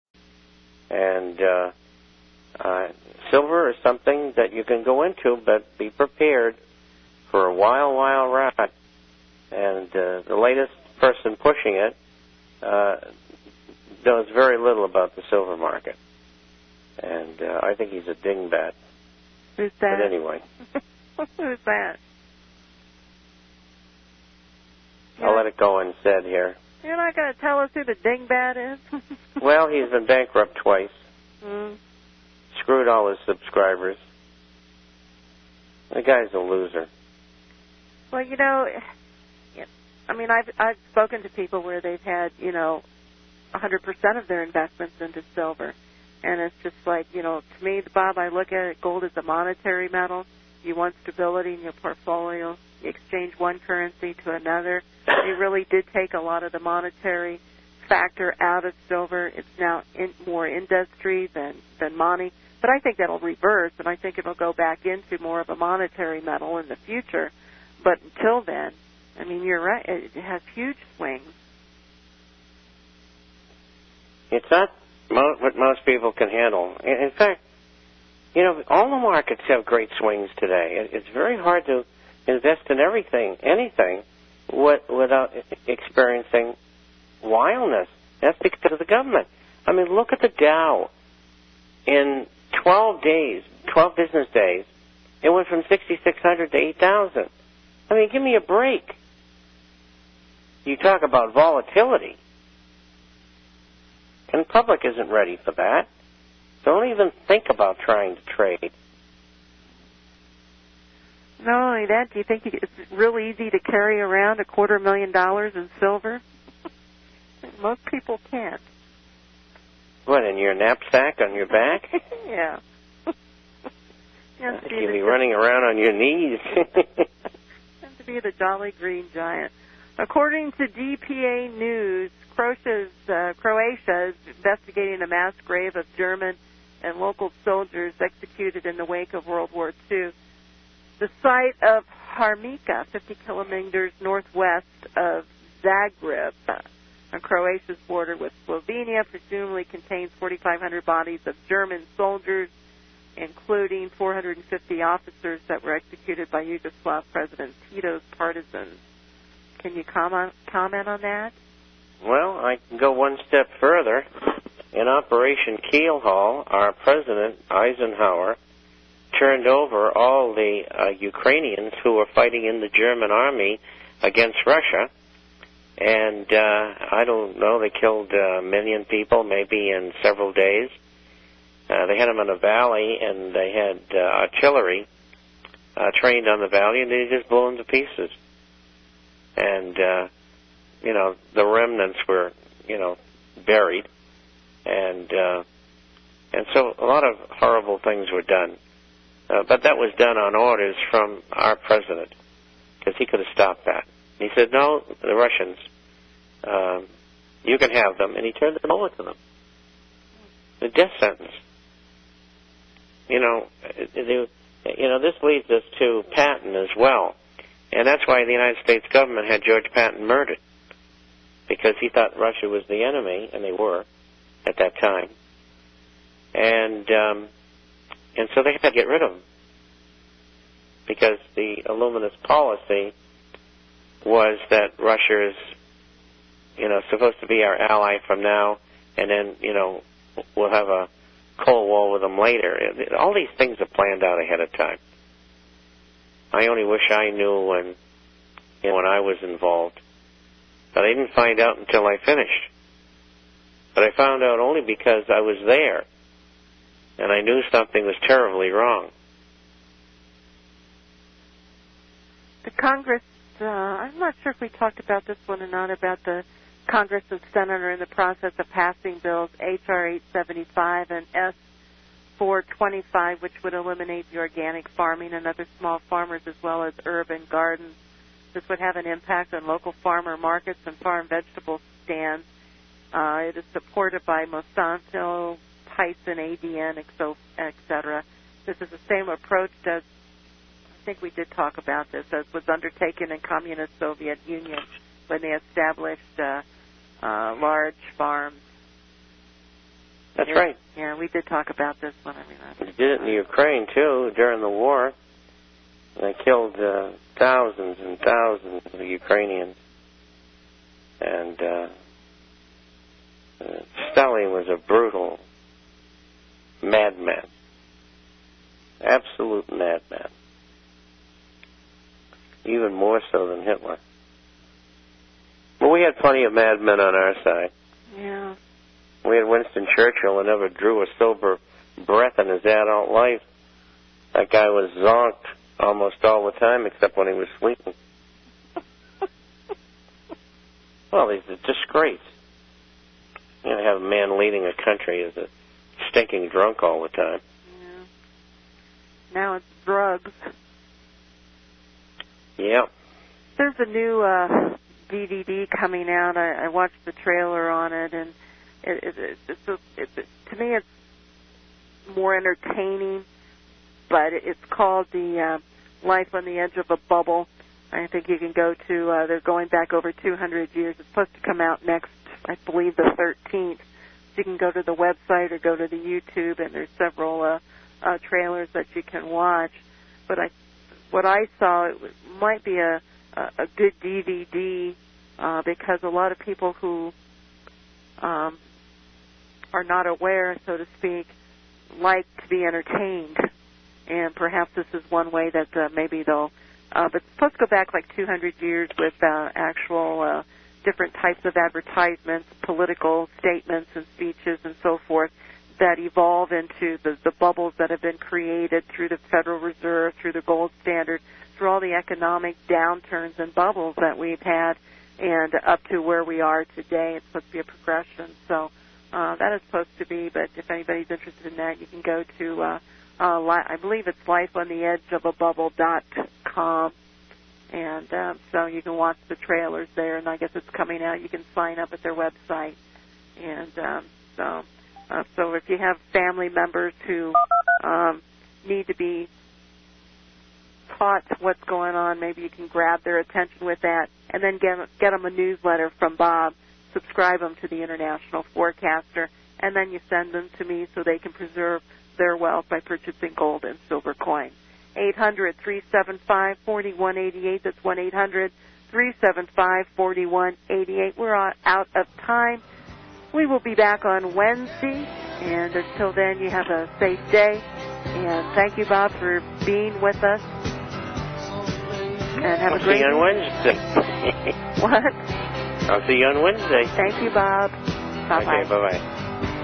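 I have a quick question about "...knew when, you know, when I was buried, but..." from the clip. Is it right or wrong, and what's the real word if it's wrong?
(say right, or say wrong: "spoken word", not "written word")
wrong: "involved", not "buried".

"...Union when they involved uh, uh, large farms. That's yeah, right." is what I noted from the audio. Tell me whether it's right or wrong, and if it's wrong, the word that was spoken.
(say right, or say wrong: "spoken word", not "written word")
wrong: "established", not "involved".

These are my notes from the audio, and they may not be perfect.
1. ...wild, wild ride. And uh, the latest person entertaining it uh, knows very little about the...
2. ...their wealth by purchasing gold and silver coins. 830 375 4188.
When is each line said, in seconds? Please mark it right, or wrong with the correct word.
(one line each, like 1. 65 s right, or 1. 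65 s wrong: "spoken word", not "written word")
1. 7 s wrong: "pushing", not "entertaining"
2. 451 s wrong: "800", not "830".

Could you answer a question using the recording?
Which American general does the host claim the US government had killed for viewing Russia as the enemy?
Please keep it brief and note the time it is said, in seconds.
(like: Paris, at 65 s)
George Patton, at 219 s.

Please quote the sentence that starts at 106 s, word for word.
Don't even think about trying to trade.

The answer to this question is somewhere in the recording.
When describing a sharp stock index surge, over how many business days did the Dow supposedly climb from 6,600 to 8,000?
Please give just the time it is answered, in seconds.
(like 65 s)
93 s.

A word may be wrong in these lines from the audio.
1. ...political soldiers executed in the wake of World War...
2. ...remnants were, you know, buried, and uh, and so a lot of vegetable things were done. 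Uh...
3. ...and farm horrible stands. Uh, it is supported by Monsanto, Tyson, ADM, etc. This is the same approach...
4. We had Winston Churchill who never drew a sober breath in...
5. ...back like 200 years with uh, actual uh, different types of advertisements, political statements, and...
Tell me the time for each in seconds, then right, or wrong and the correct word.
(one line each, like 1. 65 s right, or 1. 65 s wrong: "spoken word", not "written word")
1. 136 s wrong: "local", not "political"
2. 191 s wrong: "horrible", not "vegetable"
3. 280 s wrong: "vegetable", not "horrible"
4. 329 s right
5. 397 s right.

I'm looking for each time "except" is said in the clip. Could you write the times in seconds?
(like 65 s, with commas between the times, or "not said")
336 s.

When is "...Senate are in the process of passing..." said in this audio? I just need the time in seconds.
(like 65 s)
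267 s.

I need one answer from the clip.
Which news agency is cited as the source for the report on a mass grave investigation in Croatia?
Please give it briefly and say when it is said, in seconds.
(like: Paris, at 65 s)
DPA News, at 130 s.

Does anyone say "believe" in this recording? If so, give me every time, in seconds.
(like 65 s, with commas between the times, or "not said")
372 s, 423 s.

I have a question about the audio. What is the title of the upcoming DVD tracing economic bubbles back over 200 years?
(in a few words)
Life on the Edge of a Bubble.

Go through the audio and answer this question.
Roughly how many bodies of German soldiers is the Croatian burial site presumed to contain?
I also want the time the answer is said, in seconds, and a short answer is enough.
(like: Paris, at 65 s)
4,500, at 150 s.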